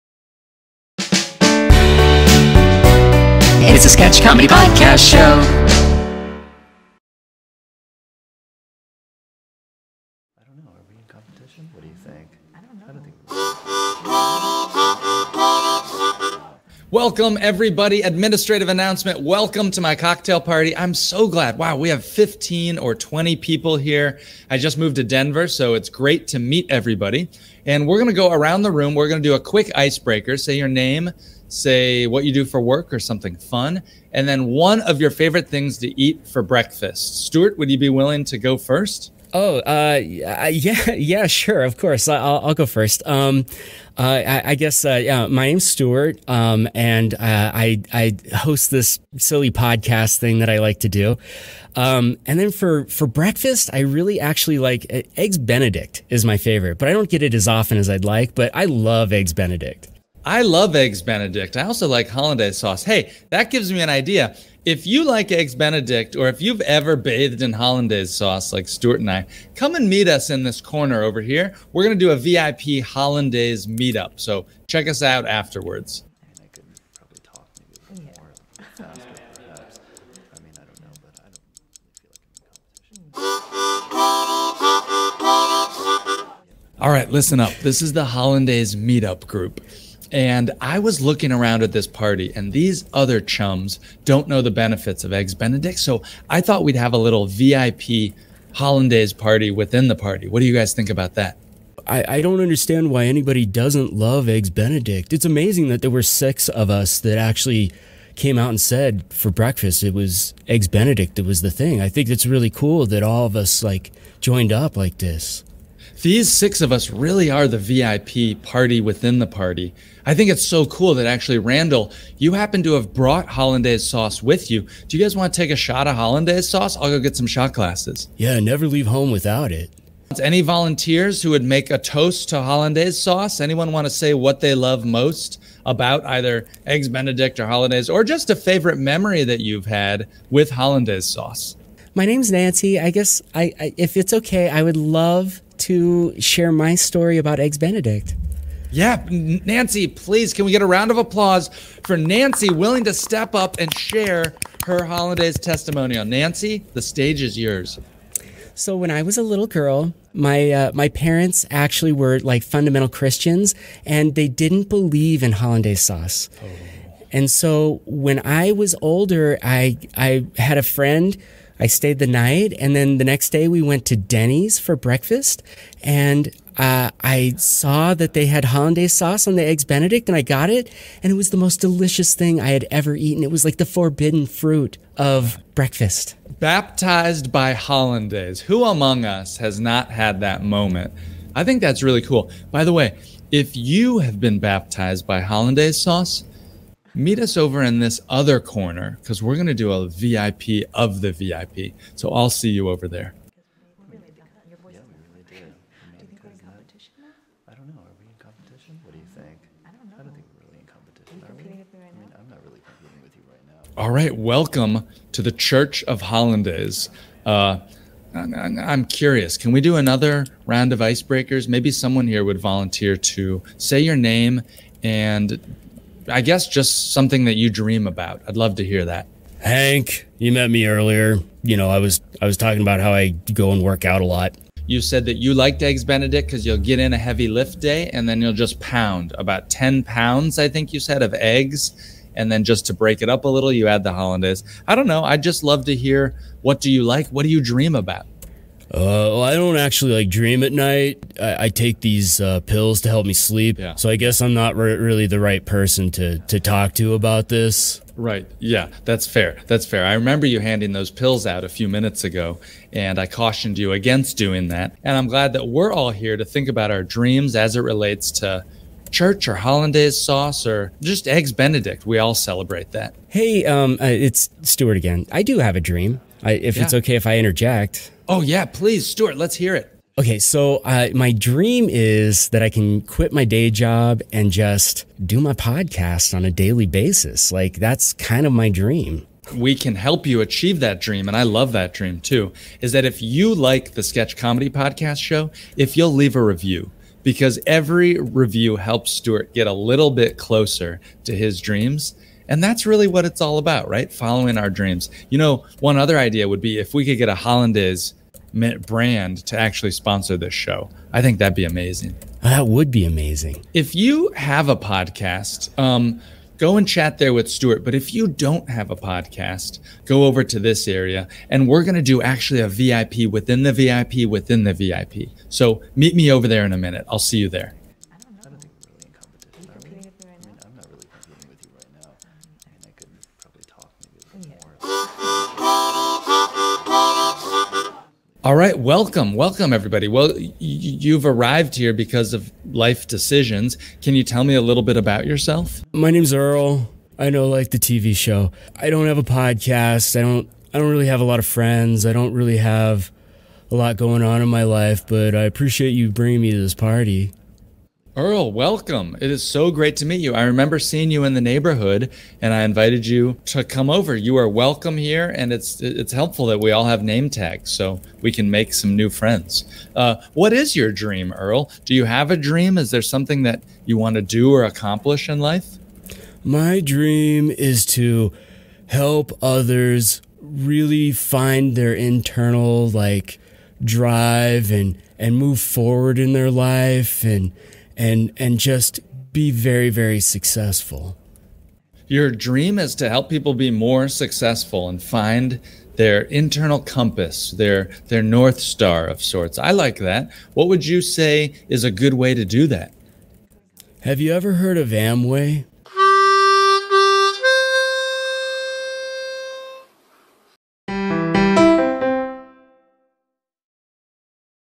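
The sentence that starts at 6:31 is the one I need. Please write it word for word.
Your dream is to help people be more successful and find their internal compass, their their north star of sorts.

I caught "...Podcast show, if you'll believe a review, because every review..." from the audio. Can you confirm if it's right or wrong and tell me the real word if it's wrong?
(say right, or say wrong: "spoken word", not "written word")
wrong: "leave", not "believe".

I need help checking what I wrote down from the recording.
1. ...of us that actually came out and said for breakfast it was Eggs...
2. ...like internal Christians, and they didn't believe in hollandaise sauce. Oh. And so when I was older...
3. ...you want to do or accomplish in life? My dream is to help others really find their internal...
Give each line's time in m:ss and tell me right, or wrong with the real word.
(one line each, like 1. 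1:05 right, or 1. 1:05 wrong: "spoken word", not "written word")
1. 1:46 right
2. 2:42 wrong: "fundamental", not "internal"
3. 6:13 right.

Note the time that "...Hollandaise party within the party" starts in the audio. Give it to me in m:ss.
1:38.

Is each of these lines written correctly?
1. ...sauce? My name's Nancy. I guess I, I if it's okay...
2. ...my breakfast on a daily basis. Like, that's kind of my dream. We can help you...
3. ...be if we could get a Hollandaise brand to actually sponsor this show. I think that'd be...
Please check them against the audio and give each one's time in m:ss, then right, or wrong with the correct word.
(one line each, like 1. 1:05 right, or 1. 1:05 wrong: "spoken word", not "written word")
1. 2:21 right
2. 4:45 wrong: "podcast", not "breakfast"
3. 5:06 right.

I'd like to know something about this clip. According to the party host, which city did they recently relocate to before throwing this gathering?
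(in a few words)
Denver.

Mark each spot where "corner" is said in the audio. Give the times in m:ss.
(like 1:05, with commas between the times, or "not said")
1:10, 3:18.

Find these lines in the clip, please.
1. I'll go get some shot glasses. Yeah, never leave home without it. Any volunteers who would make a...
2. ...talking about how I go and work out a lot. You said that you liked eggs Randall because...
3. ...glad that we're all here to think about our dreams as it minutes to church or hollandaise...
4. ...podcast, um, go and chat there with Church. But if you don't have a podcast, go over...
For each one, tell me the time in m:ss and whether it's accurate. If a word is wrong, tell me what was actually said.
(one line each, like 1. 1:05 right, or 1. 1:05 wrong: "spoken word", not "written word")
1. 2:06 right
2. 3:52 wrong: "Benedict", not "Randall"
3. 4:25 wrong: "relates", not "minutes"
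4. 5:14 wrong: "Stuart", not "Church".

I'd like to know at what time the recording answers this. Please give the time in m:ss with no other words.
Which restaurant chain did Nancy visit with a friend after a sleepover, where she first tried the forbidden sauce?
2:53.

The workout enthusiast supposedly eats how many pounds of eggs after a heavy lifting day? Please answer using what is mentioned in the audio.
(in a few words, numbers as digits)
10.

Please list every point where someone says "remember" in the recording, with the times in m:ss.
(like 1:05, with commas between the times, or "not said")
4:19, 6:00.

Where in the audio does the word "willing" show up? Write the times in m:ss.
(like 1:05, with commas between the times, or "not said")
0:37, 2:32.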